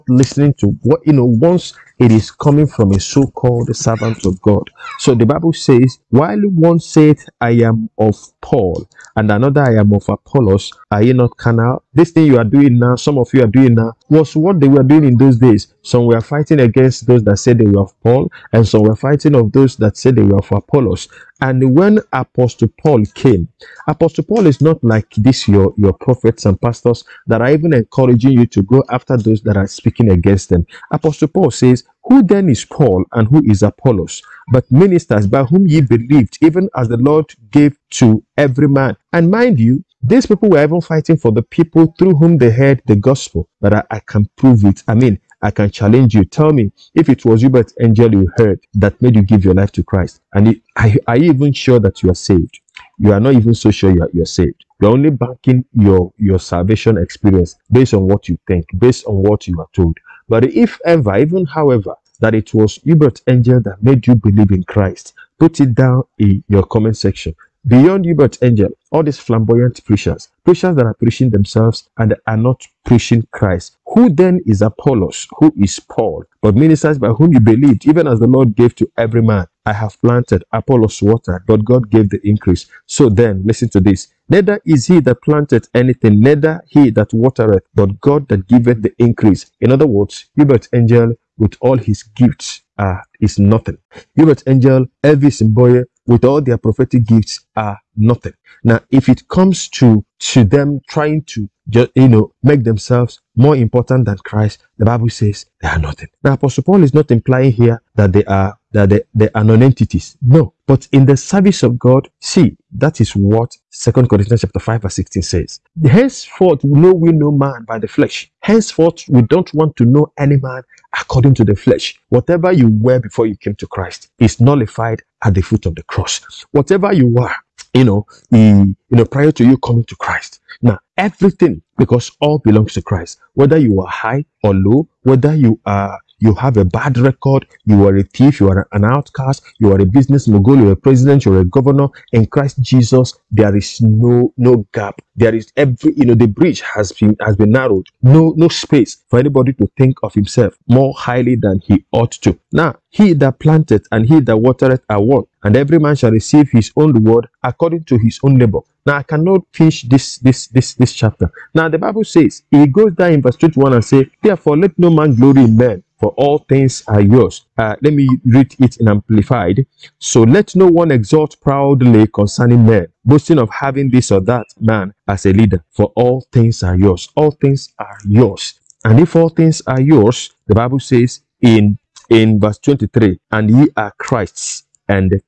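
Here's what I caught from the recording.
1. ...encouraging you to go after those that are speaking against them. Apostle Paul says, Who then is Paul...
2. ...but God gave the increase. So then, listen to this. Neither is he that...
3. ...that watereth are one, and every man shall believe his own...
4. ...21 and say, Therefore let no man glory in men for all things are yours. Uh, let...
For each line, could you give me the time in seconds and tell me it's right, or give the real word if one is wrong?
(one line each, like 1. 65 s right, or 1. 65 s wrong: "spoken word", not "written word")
1. 27 s right
2. 81 s right
3. 154 s wrong: "receive", not "believe"
4. 163 s right.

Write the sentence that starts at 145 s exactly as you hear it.
There is every you know the bridge has been has been narrowed.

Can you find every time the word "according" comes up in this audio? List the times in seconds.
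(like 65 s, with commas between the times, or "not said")
120 s, 157 s.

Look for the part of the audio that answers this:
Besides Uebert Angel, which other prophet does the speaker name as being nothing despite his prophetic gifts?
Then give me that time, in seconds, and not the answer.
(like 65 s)
95 s.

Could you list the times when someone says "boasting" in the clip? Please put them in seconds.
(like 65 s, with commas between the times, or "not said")
173 s.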